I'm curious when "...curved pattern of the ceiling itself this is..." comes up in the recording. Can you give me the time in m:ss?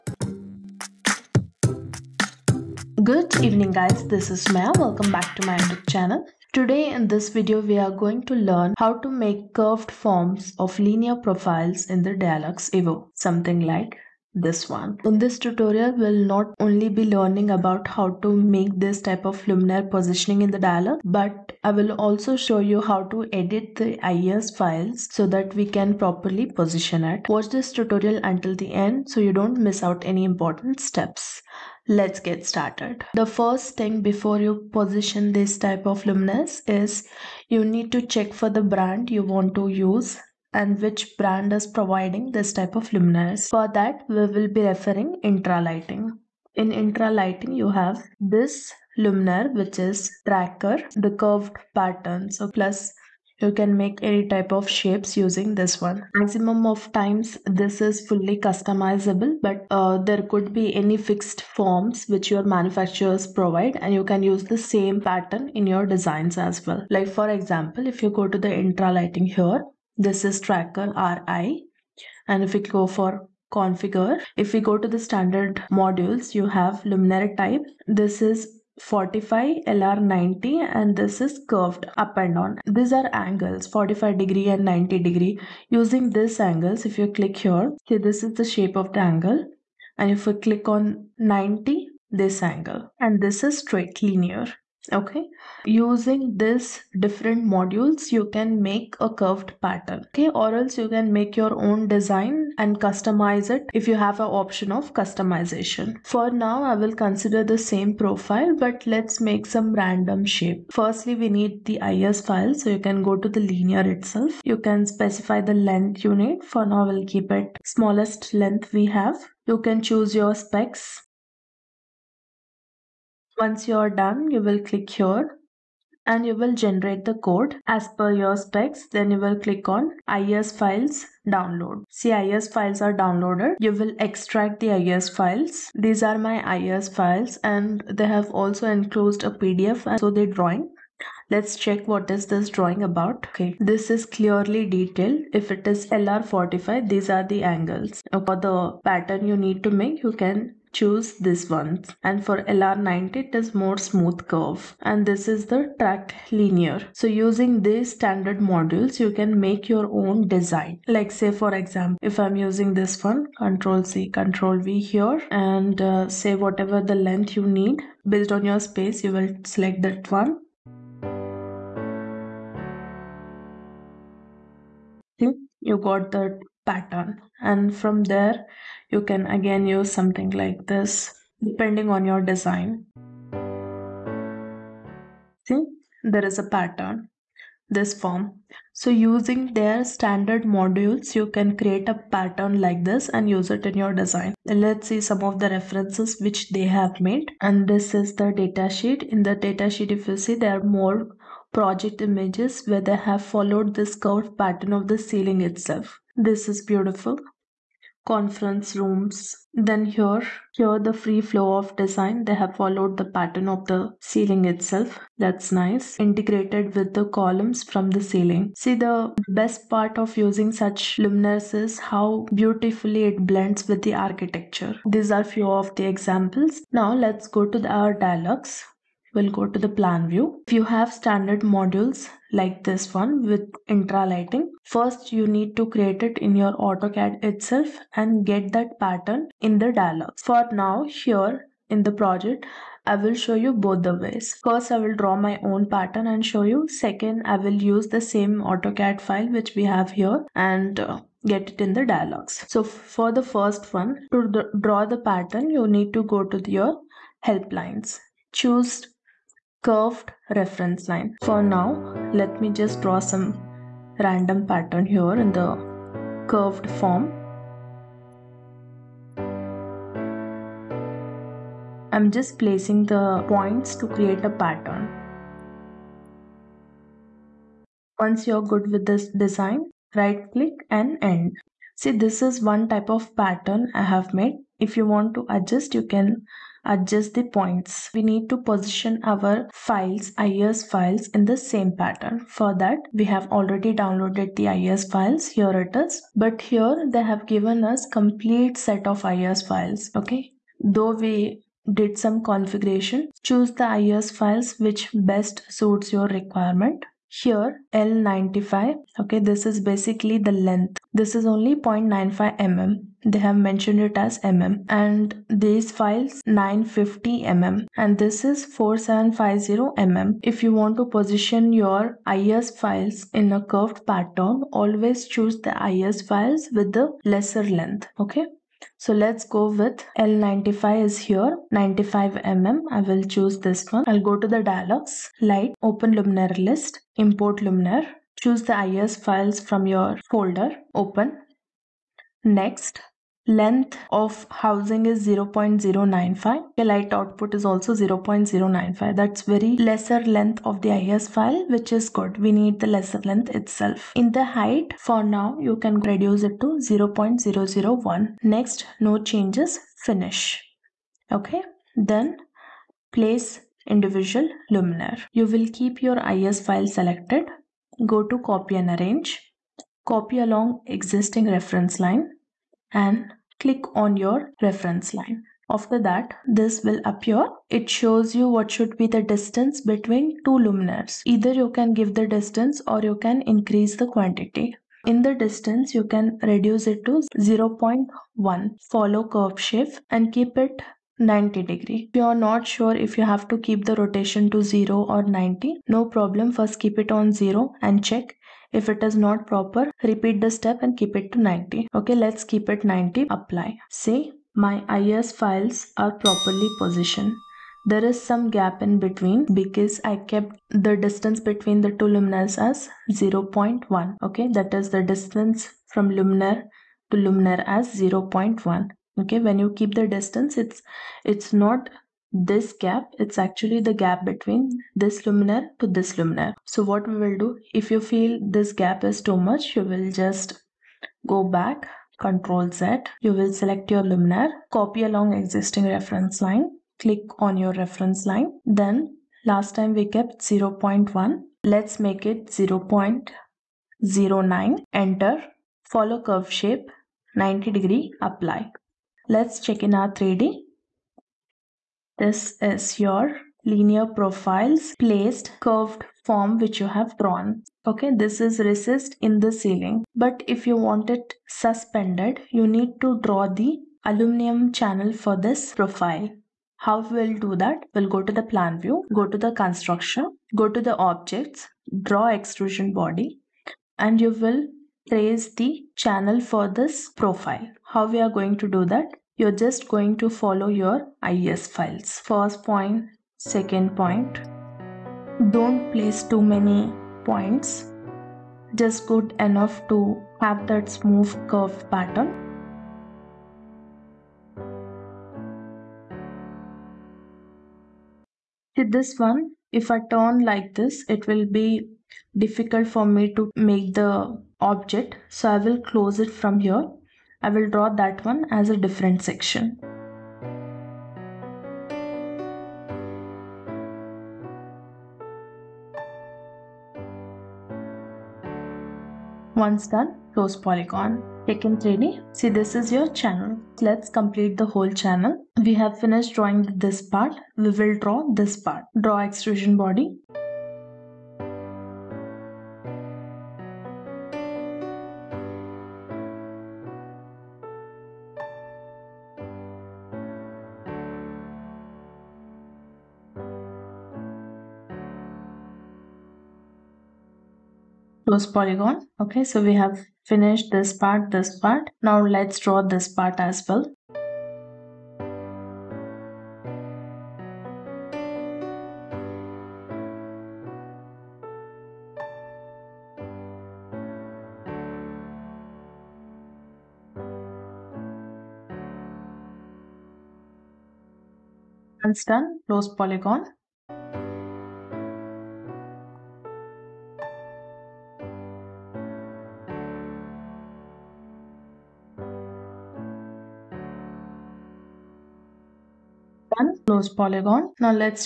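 3:23.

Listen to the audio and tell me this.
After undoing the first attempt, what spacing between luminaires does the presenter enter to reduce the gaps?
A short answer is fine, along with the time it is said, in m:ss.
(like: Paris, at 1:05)
0.09, at 7:22.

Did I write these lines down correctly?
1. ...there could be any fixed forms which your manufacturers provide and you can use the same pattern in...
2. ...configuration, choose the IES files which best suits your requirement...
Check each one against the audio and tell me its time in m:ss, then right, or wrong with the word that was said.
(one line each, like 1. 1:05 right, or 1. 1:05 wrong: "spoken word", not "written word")
1. 0:59 right
2. 5:02 right.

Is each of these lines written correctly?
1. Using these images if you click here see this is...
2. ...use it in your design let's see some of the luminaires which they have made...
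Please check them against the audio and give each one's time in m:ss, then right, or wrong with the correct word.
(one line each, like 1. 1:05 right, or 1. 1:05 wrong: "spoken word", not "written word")
1. 1:25 wrong: "angles", not "images"
2. 3:13 wrong: "references", not "luminaires".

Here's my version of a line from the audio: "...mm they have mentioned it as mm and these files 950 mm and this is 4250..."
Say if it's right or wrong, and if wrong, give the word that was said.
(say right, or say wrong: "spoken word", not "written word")
wrong: "4750", not "4250".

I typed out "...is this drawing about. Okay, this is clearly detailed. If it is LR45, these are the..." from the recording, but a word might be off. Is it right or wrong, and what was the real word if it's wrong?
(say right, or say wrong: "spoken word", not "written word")
right.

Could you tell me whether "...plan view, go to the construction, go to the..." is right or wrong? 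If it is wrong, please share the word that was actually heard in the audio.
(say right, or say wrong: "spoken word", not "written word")
right.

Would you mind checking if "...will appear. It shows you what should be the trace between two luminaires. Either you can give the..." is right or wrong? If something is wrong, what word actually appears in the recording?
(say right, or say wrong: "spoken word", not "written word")
wrong: "distance", not "trace".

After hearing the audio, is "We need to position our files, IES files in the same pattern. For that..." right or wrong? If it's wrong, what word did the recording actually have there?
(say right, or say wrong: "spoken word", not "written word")
right.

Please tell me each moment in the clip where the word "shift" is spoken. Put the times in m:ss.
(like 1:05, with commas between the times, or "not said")
6:29.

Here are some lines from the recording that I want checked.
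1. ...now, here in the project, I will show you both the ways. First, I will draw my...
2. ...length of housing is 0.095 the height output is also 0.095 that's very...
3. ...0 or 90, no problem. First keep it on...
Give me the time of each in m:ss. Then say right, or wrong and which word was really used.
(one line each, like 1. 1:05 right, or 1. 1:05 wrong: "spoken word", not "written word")
1. 4:00 right
2. 5:43 wrong: "light", not "height"
3. 6:34 right.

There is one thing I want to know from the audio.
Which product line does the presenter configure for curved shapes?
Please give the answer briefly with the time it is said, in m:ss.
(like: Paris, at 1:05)
Tracker RI, at 1:10.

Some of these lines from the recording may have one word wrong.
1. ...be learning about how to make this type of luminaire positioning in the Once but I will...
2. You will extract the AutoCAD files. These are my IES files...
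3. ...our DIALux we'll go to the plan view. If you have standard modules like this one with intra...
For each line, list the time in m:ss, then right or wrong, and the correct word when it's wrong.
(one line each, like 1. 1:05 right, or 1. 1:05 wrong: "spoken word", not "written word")
1. 0:16 wrong: "DIALux", not "Once"
2. 2:13 wrong: "IES", not "AutoCAD"
3. 3:47 right.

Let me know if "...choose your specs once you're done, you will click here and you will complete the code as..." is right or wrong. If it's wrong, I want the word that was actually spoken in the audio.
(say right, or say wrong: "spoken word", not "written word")
wrong: "generate", not "complete".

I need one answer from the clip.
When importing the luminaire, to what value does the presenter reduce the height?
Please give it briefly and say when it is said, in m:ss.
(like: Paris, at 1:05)
0.001, at 5:56.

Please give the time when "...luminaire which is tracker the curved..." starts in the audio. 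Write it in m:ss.
0:48.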